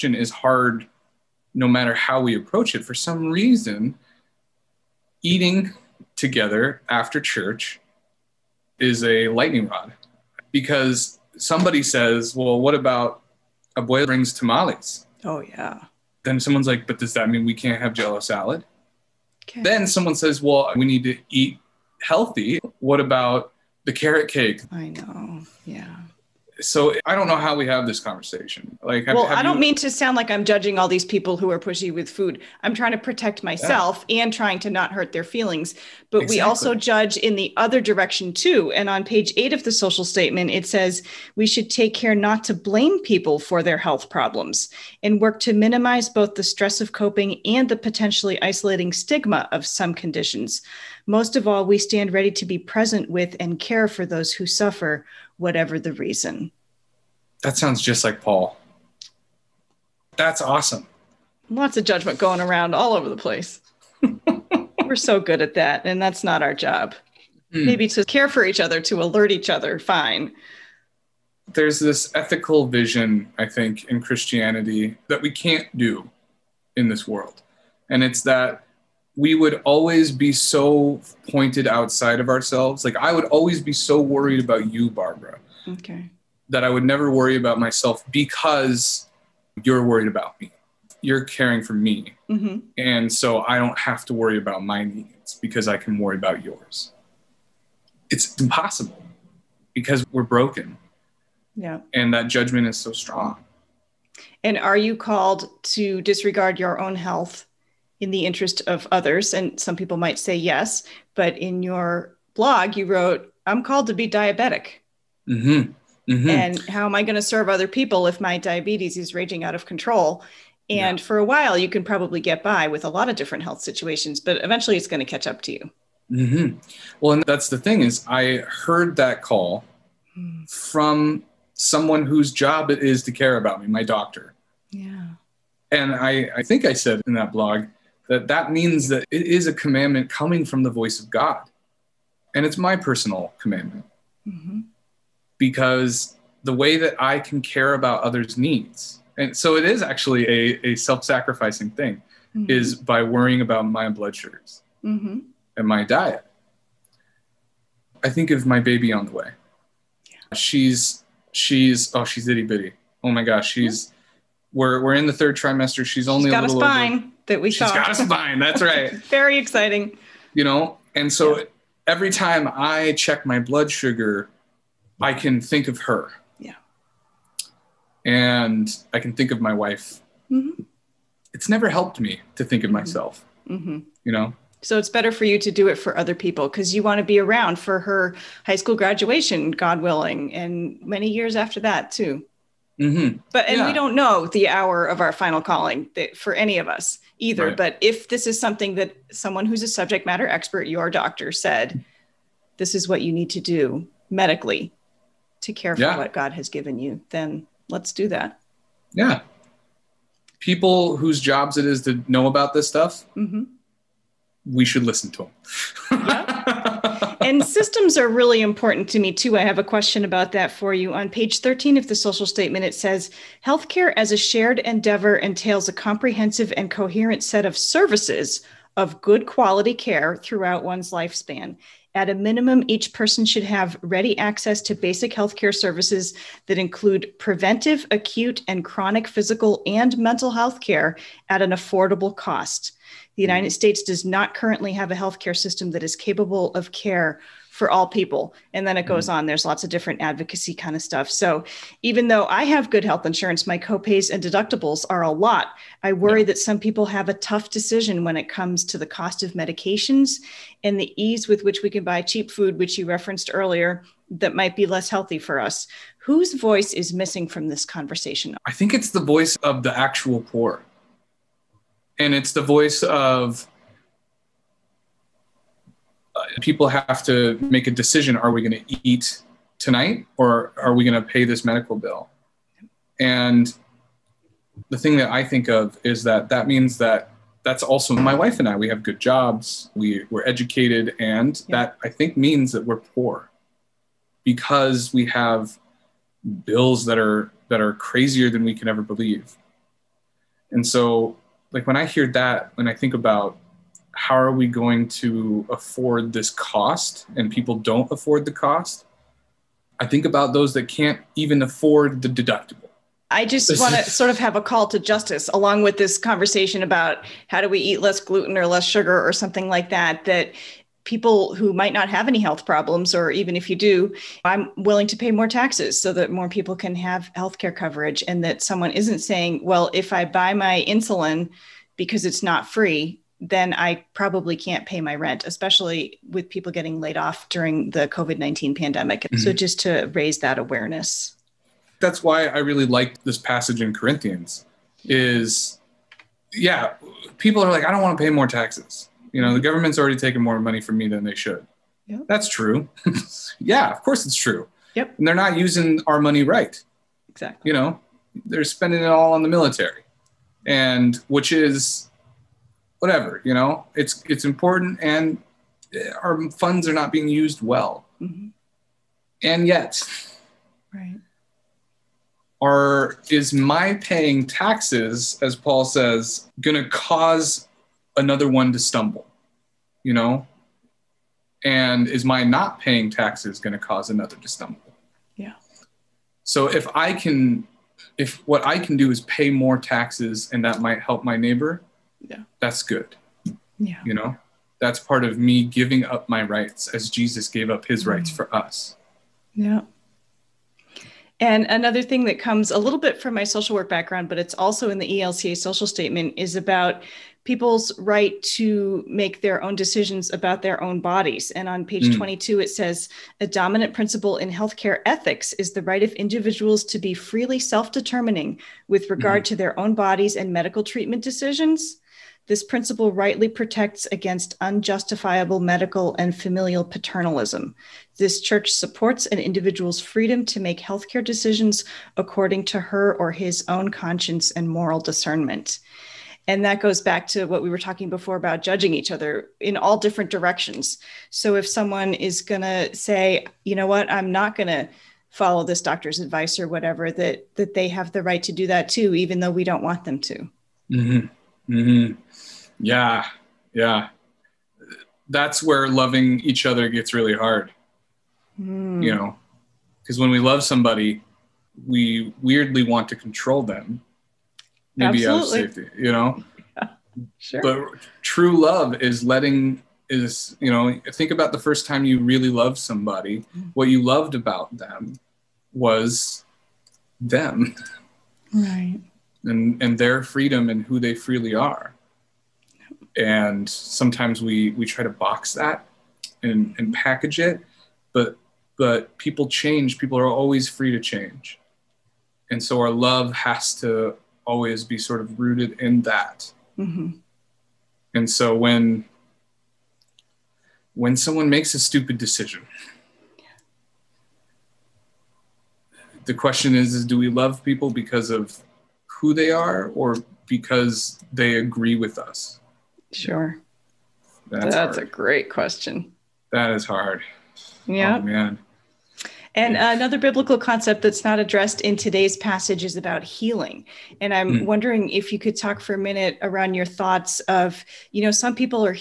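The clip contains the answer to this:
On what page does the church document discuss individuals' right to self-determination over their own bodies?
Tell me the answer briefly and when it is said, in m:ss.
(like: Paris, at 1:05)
22, at 6:51.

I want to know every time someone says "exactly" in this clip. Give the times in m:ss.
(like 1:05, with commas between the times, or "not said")
0:36, 5:57.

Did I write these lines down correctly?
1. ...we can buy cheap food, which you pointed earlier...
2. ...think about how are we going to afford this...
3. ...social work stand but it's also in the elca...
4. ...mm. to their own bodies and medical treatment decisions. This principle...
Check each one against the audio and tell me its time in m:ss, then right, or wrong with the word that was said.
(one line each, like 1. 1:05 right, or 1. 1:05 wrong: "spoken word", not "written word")
1. 4:21 wrong: "referenced", not "pointed"
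2. 5:02 right
3. 6:43 wrong: "background", not "stand"
4. 6:59 right.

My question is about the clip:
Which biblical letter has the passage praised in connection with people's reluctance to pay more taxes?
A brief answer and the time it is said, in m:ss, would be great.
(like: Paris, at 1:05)
Corinthians, at 5:43.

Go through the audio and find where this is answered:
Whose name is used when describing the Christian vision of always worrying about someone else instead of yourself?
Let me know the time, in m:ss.
1:24.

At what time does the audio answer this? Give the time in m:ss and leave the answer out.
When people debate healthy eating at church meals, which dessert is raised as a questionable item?
0:23.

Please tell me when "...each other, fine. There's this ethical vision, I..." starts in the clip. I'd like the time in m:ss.
1:09.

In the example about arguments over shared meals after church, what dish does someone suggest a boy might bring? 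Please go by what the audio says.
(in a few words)
Tamales.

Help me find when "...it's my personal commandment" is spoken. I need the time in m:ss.
2:22.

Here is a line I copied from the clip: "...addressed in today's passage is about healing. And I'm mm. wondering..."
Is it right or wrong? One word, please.
right.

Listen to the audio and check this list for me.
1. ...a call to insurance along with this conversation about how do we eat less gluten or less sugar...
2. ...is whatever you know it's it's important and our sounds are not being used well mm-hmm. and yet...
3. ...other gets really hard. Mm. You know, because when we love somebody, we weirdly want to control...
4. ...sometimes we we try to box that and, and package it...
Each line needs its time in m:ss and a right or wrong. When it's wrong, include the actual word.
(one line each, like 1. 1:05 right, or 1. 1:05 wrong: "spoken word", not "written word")
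1. 5:14 wrong: "justice", not "insurance"
2. 6:01 wrong: "funds", not "sounds"
3. 7:36 right
4. 8:03 right.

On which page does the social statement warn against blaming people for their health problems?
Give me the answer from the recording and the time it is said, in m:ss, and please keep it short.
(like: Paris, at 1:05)
8, at 0:39.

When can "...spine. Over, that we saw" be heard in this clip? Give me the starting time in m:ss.
2:46.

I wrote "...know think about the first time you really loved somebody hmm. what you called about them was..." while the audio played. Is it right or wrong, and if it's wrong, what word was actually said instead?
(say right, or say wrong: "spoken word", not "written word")
wrong: "loved", not "called".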